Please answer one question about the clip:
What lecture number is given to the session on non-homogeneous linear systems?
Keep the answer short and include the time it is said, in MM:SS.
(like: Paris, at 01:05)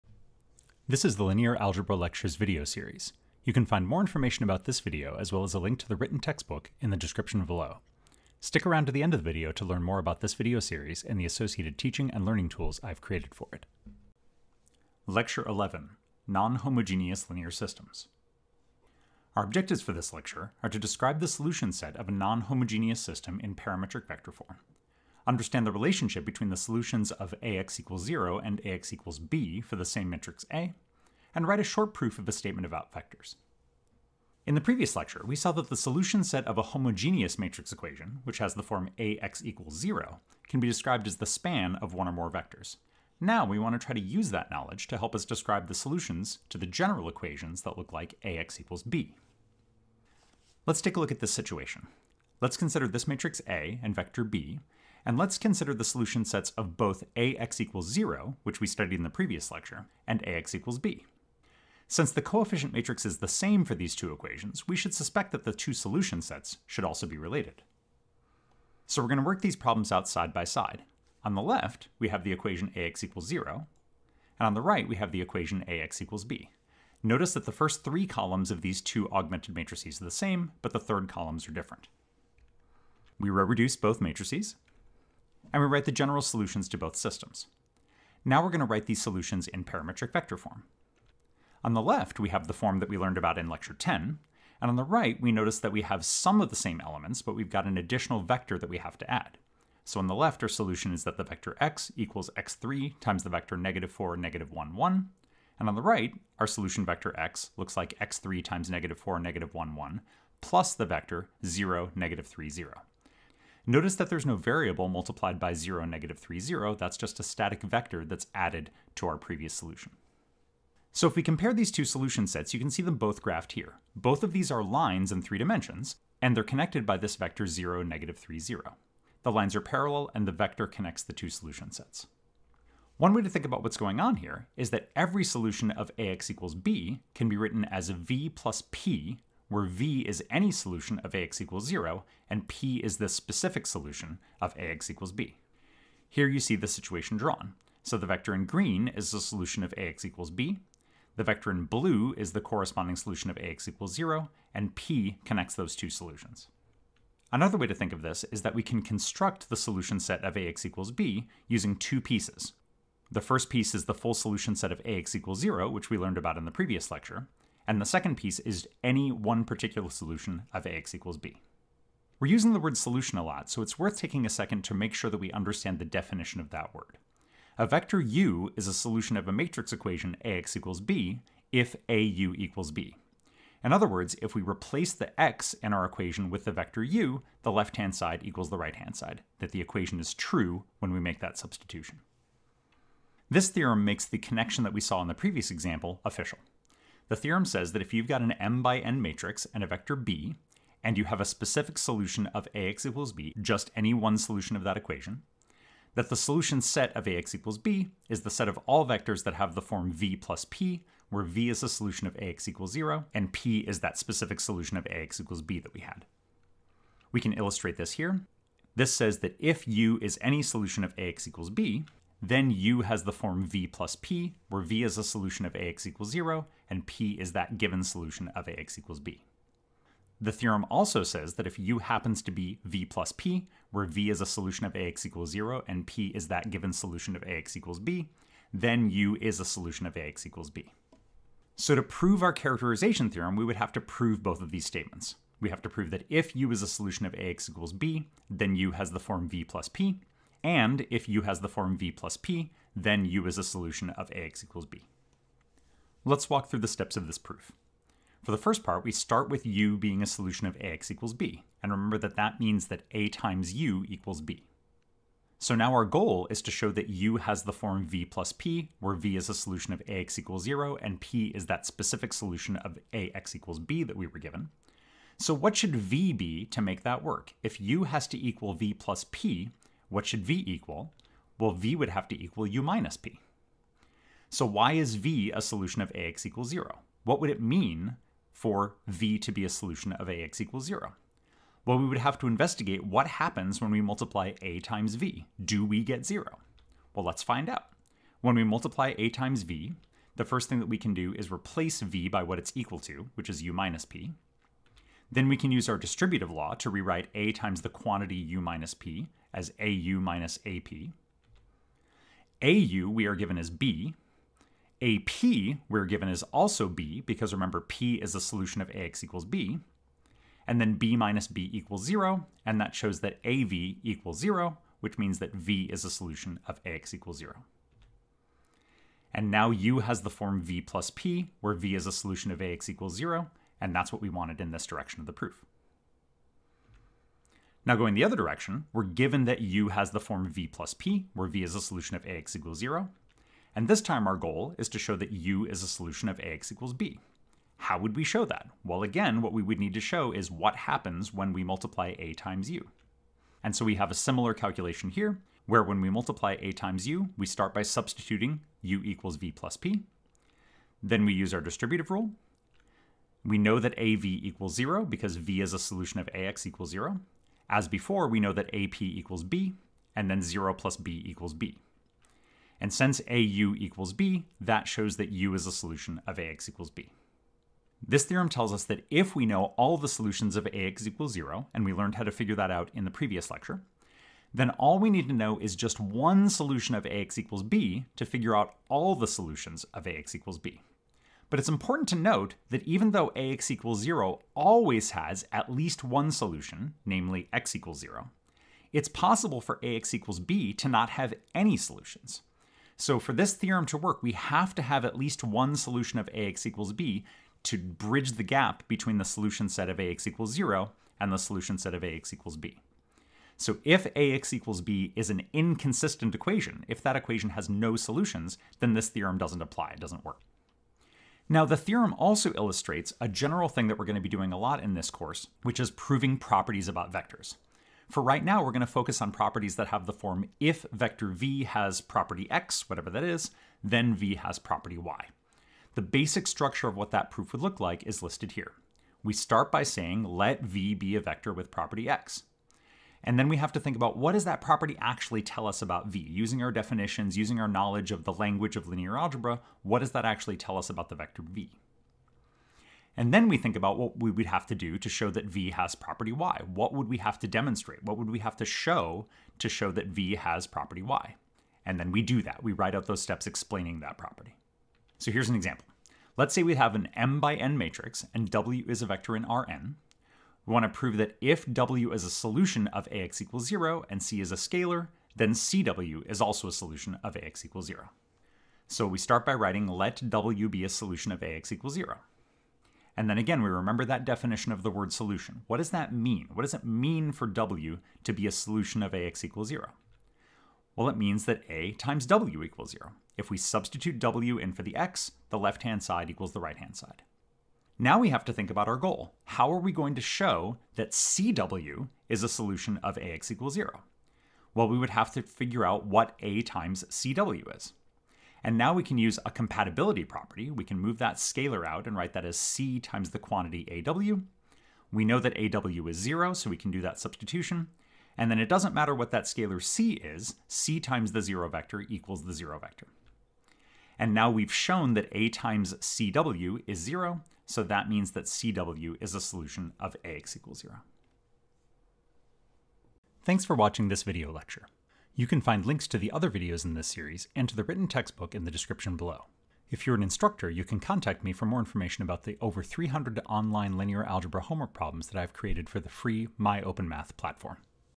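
11, at 00:15.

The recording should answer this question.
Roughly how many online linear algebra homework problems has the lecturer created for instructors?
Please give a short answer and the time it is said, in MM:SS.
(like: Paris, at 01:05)
over 300, at 09:02.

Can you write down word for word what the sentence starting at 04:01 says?
So to prove our characterization theorem, we would have to prove both of these statements.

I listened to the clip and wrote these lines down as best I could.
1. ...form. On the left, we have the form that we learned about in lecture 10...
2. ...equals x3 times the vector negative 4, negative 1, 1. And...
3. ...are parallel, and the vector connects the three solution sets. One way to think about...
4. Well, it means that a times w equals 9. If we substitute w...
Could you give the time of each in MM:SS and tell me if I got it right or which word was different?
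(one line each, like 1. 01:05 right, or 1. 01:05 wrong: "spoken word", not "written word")
1. 01:30 right
2. 01:41 right
3. 02:09 wrong: "two", not "three"
4. 08:10 wrong: "0", not "9".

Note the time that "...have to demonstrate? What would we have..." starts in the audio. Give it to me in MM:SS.
07:36.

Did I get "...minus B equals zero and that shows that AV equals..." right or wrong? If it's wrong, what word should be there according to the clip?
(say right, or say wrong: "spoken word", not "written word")
right.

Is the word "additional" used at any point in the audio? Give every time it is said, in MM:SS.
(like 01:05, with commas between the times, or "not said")
01:37.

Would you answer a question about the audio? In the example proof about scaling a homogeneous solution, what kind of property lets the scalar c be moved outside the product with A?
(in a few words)
Compatibility property.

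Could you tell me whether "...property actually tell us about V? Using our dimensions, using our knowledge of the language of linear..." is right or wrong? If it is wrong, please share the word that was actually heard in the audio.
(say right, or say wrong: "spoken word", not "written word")
wrong: "definitions", not "dimensions".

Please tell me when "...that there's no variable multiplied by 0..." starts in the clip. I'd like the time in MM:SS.
01:53.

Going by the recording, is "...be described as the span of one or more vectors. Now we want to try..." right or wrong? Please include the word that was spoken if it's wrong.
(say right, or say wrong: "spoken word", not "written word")
right.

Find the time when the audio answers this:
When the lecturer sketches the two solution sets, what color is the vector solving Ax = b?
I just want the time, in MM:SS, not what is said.
02:28.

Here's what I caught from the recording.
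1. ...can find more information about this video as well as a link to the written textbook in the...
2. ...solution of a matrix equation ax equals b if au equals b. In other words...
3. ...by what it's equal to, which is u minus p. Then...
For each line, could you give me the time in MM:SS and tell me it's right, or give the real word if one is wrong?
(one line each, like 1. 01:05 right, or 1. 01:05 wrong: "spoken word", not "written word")
1. 00:03 right
2. 02:58 right
3. 05:02 right.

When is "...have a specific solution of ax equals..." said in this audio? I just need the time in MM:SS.
03:21.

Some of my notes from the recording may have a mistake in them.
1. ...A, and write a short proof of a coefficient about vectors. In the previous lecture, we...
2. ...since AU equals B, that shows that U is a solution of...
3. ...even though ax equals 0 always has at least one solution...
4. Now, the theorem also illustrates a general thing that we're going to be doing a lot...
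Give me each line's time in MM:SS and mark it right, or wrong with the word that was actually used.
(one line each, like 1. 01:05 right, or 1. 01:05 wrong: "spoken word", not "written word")
1. 00:30 wrong: "statement", not "coefficient"
2. 06:12 right
3. 06:32 right
4. 07:01 right.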